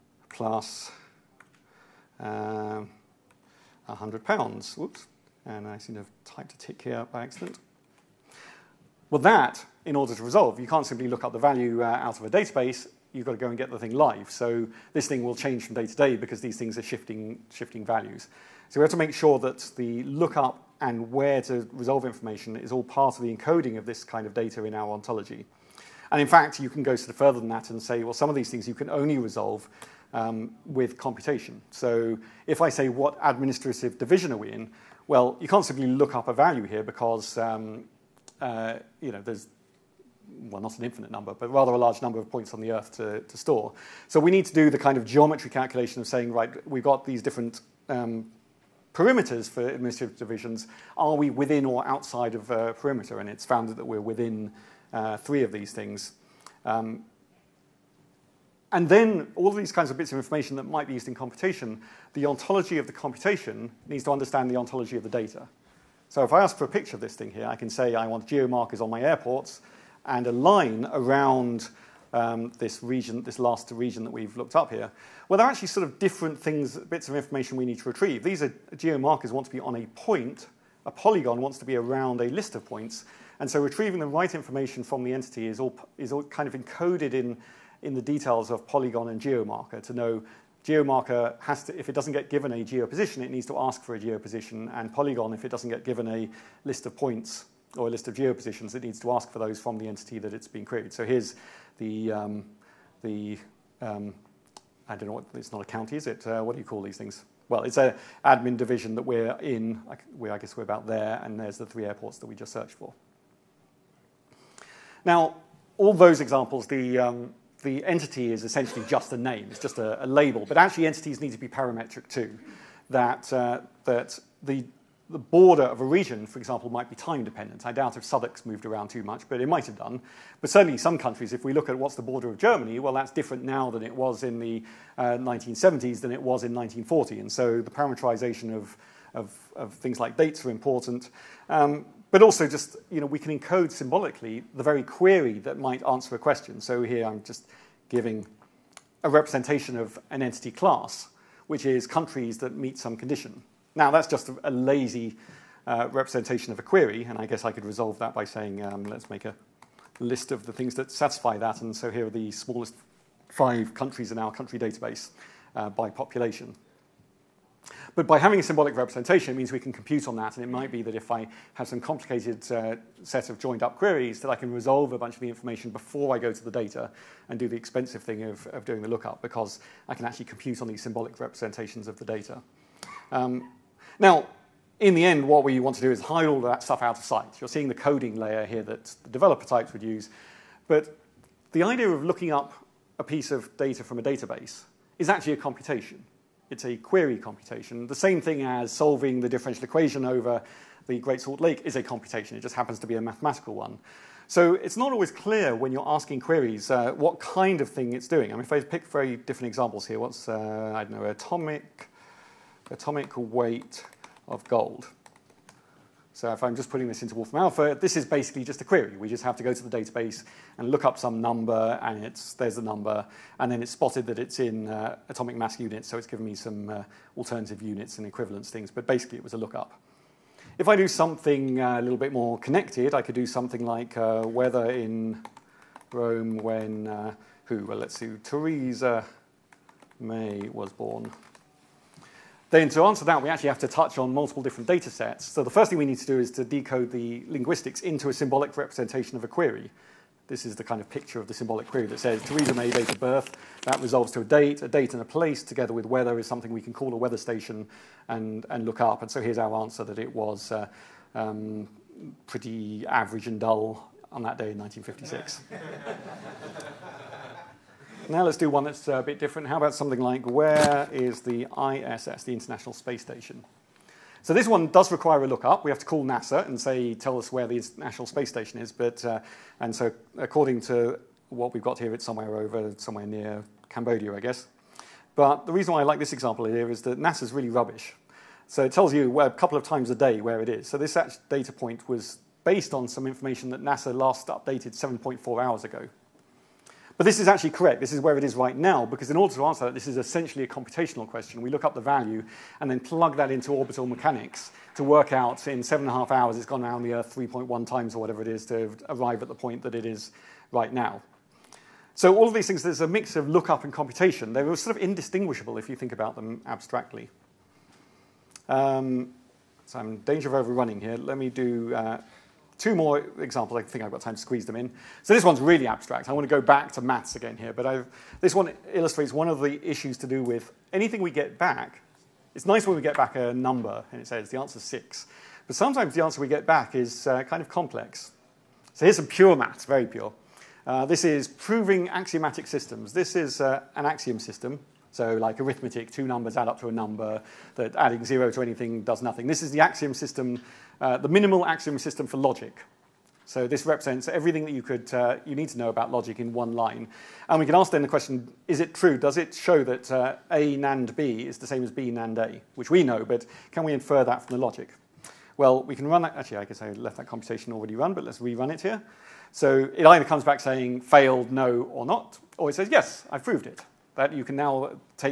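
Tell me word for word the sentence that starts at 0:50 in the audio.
Are we within or outside of a perimeter?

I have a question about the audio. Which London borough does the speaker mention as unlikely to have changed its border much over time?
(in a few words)
Southwark.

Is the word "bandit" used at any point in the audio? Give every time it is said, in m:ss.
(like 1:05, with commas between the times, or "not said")
not said.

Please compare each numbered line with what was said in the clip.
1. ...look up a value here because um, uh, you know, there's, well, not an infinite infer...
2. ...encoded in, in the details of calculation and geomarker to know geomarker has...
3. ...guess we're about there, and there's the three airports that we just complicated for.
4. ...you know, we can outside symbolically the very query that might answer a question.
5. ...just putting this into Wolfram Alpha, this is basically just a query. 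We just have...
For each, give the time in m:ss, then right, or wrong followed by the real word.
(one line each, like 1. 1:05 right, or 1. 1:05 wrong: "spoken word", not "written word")
1. 0:35 wrong: "number", not "infer"
2. 1:26 wrong: "polygon", not "calculation"
3. 1:50 wrong: "searched", not "complicated"
4. 2:22 wrong: "encode", not "outside"
5. 3:36 right.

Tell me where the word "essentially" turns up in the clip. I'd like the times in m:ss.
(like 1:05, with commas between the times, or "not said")
1:58, 4:59.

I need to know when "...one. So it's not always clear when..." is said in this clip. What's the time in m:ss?
3:23.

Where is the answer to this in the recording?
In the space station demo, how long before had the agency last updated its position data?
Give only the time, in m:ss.
4:54.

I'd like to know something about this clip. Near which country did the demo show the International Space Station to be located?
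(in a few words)
Cambodia.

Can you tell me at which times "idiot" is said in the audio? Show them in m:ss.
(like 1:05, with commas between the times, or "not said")
not said.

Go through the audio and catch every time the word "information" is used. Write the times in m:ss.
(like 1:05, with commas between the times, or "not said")
0:22, 1:00, 1:17, 1:24, 2:55, 4:53.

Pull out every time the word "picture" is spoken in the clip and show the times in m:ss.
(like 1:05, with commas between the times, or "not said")
1:06, 4:10.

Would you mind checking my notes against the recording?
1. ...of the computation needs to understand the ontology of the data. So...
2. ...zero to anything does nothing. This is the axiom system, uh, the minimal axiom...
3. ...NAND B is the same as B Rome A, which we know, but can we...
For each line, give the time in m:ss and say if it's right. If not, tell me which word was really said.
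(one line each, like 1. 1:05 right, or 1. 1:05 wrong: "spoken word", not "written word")
1. 1:02 right
2. 5:48 right
3. 6:00 wrong: "NAND", not "Rome".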